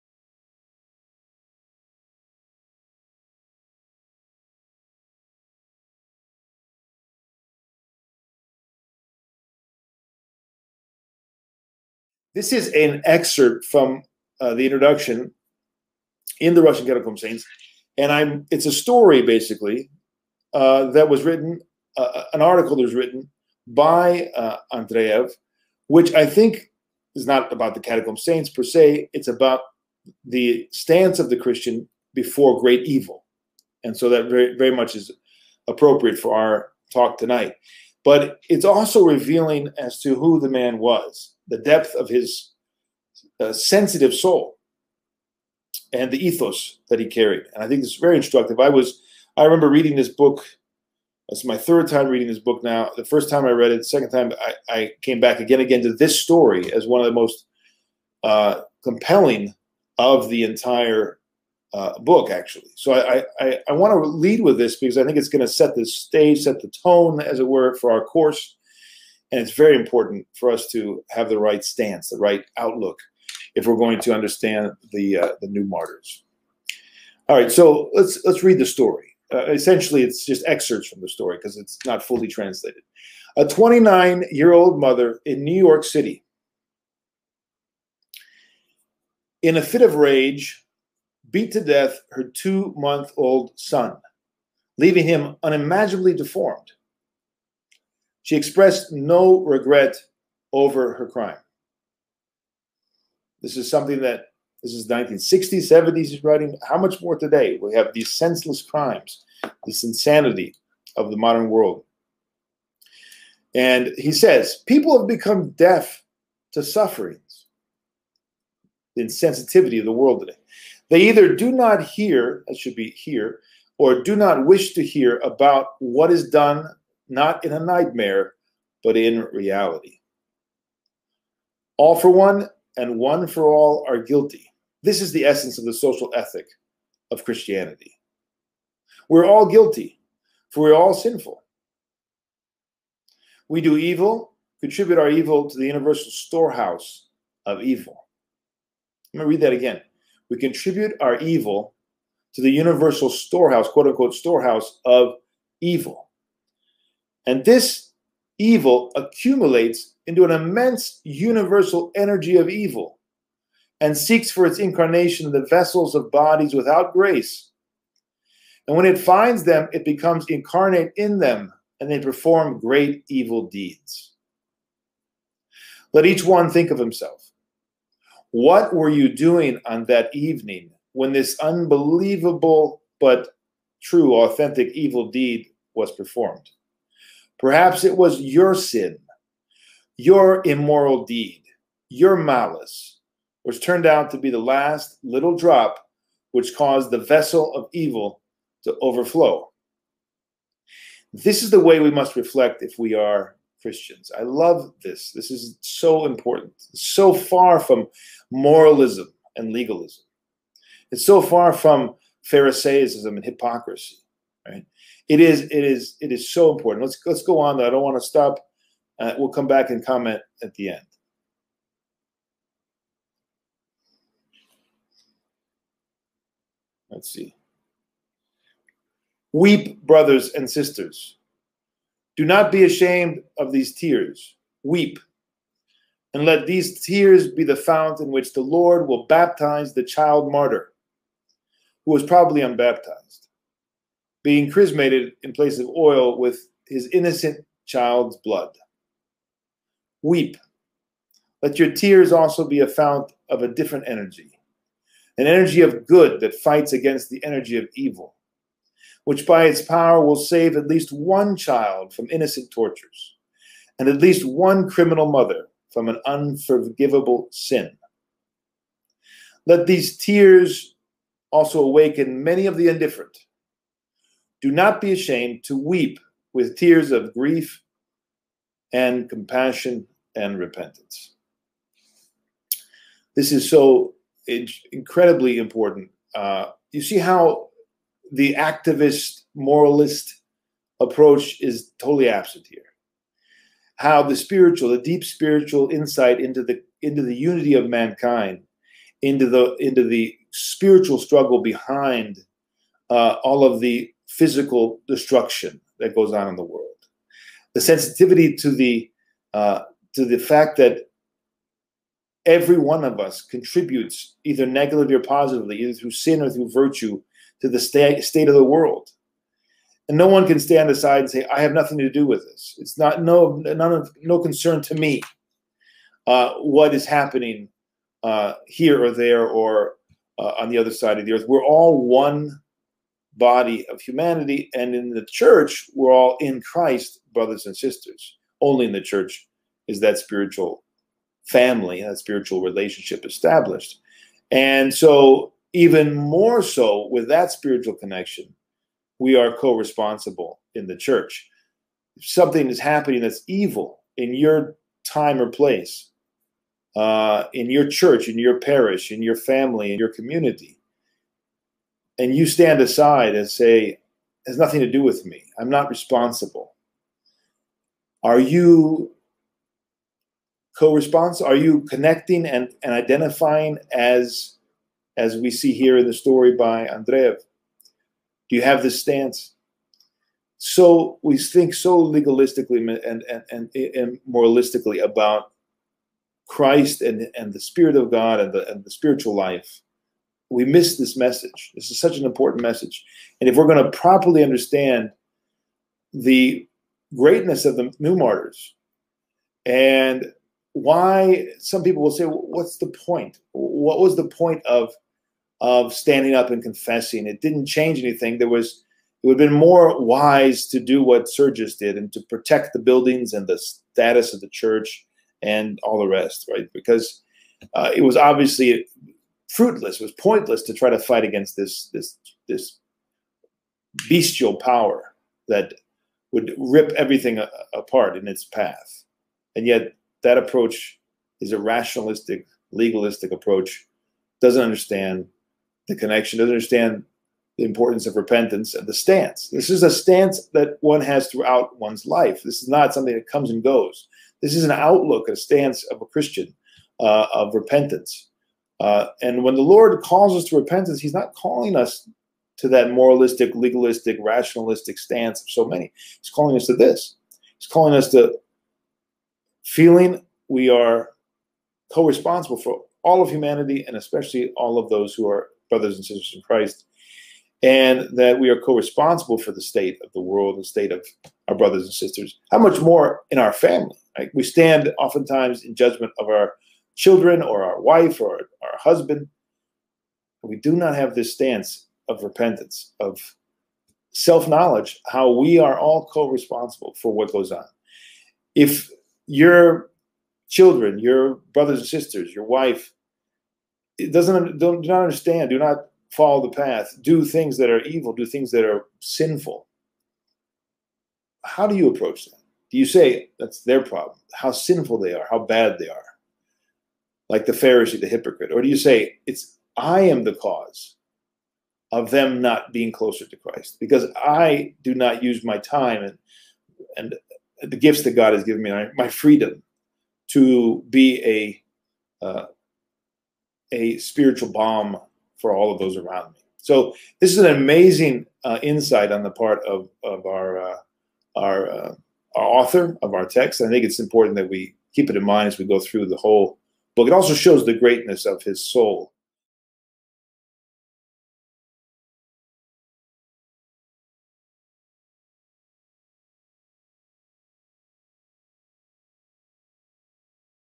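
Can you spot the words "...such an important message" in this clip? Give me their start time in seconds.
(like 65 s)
391 s.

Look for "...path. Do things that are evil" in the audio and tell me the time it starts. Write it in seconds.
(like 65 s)
496 s.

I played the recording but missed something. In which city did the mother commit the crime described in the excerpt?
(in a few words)
New York City.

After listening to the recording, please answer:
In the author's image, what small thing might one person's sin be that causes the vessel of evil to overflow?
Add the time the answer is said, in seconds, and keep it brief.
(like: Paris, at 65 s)
the last little drop, at 194 s.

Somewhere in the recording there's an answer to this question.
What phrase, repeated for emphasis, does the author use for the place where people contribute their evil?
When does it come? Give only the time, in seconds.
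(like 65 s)
145 s.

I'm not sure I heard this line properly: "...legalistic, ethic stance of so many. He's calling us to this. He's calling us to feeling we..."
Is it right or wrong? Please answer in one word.
wrong.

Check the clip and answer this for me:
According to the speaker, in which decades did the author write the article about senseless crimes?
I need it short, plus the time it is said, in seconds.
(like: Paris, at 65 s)
1960s and 70s, at 104 s.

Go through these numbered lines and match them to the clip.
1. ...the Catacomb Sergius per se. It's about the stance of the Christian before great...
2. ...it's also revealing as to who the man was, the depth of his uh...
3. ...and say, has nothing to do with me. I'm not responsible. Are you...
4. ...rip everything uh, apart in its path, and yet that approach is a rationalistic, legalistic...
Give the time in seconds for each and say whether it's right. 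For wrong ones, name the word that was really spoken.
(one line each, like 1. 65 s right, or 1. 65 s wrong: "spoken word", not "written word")
1. 27 s wrong: "Saints", not "Sergius"
2. 38 s right
3. 363 s right
4. 426 s right.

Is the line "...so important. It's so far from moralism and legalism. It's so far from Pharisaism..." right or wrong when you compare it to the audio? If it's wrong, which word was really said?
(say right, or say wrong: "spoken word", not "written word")
right.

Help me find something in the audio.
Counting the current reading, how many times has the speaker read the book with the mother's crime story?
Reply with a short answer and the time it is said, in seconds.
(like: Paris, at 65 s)
3, at 51 s.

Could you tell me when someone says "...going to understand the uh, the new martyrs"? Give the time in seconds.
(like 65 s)
73 s.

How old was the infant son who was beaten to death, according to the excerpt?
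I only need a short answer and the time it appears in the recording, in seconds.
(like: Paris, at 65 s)
2 months, at 92 s.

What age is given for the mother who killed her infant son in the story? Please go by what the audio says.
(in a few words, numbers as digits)
29.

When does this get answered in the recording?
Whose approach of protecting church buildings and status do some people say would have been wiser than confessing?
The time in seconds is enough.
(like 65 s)
411 s.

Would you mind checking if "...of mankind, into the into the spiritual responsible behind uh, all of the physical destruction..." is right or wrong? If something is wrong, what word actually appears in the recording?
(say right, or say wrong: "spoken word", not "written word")
wrong: "struggle", not "responsible".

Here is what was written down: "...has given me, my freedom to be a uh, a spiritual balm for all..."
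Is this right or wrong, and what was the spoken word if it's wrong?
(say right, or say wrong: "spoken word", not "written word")
right.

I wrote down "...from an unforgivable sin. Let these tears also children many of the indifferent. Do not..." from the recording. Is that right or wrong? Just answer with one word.
wrong.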